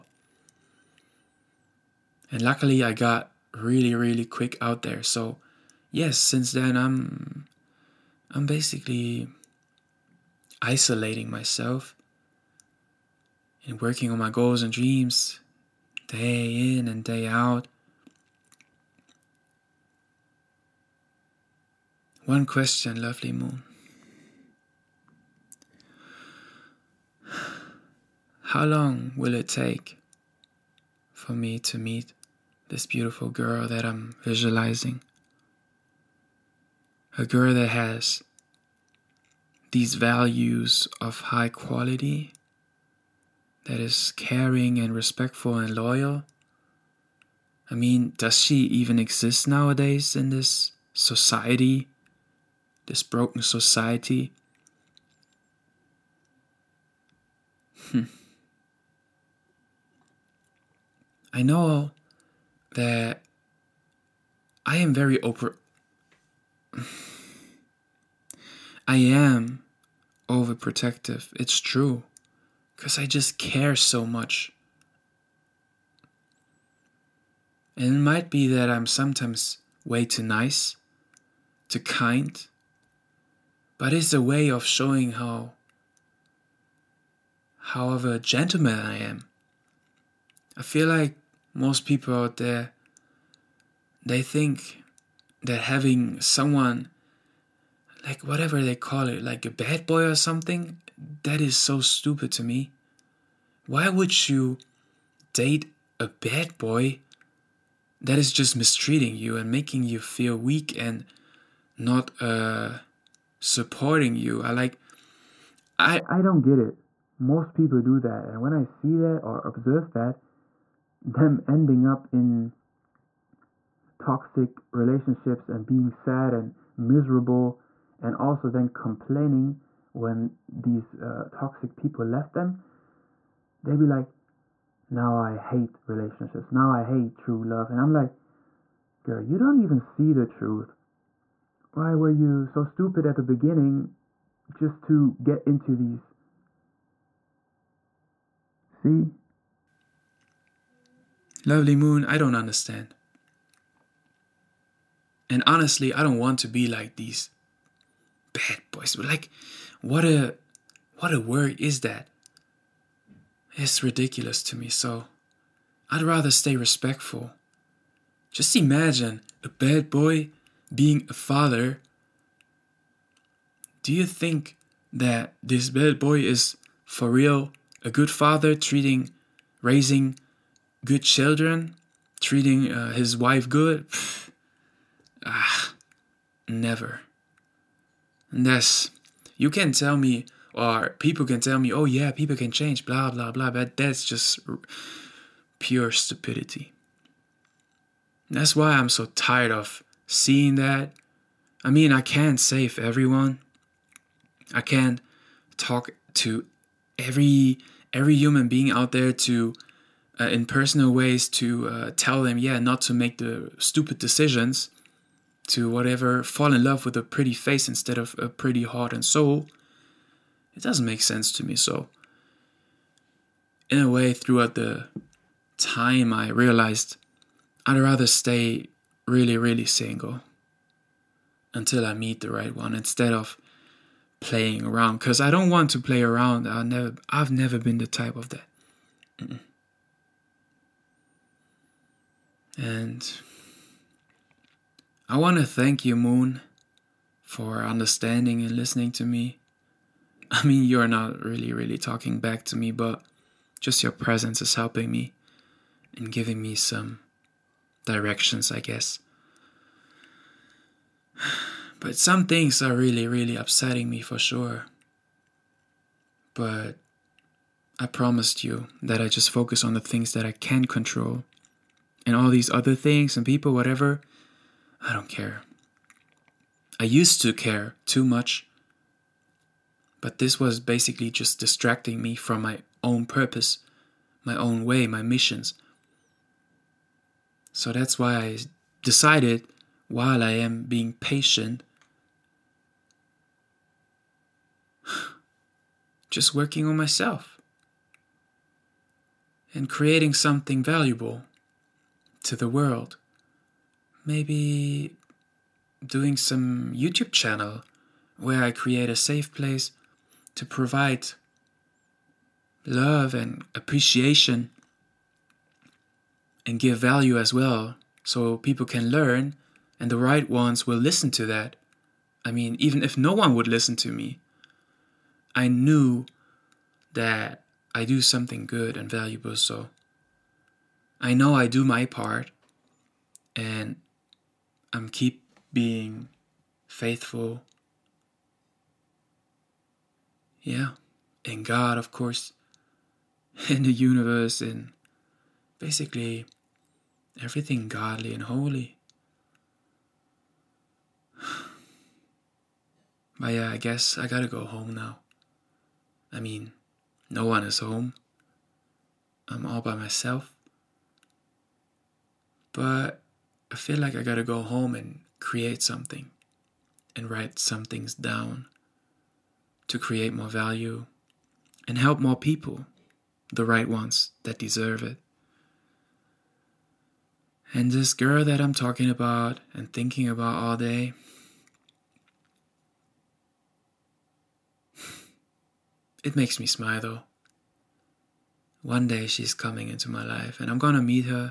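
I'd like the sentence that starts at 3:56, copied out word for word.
i never, I've never been the type of that.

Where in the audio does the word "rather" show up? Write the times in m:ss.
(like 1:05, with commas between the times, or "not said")
2:46, 3:47.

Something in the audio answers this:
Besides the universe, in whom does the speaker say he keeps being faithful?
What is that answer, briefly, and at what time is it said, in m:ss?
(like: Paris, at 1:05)
God, at 5:41.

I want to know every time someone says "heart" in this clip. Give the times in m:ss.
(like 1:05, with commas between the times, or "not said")
3:38.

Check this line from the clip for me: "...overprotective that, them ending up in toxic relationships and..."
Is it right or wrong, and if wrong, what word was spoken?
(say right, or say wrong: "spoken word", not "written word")
wrong: "observe", not "overprotective".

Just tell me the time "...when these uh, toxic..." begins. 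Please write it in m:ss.
2:09.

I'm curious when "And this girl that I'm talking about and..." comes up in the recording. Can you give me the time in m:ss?
6:17.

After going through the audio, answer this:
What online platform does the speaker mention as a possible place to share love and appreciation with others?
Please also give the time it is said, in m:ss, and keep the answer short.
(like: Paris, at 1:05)
YouTube, at 5:06.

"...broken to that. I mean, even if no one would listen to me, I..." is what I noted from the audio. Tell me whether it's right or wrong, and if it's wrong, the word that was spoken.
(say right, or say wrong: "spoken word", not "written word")
wrong: "listen", not "broken".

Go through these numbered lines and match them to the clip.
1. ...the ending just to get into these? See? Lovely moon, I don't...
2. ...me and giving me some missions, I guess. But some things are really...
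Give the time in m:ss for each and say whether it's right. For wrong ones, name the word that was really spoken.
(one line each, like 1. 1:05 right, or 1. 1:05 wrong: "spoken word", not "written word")
1. 2:23 wrong: "beginning", not "ending"
2. 4:14 wrong: "directions", not "missions".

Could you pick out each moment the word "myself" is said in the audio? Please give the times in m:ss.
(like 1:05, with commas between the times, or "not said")
0:11, 4:56, 5:59.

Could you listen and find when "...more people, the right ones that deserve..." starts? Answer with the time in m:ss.
6:12.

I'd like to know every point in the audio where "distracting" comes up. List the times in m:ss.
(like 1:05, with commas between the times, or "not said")
4:41.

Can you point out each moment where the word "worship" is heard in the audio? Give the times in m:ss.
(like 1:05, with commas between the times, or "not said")
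not said.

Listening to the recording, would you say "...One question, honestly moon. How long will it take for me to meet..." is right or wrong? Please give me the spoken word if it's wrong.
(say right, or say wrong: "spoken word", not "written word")
wrong: "lovely", not "honestly".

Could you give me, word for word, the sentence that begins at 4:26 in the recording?
But I promised you that I just focus on the things that I can control.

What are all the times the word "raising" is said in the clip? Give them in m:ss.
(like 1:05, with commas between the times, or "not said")
2:59.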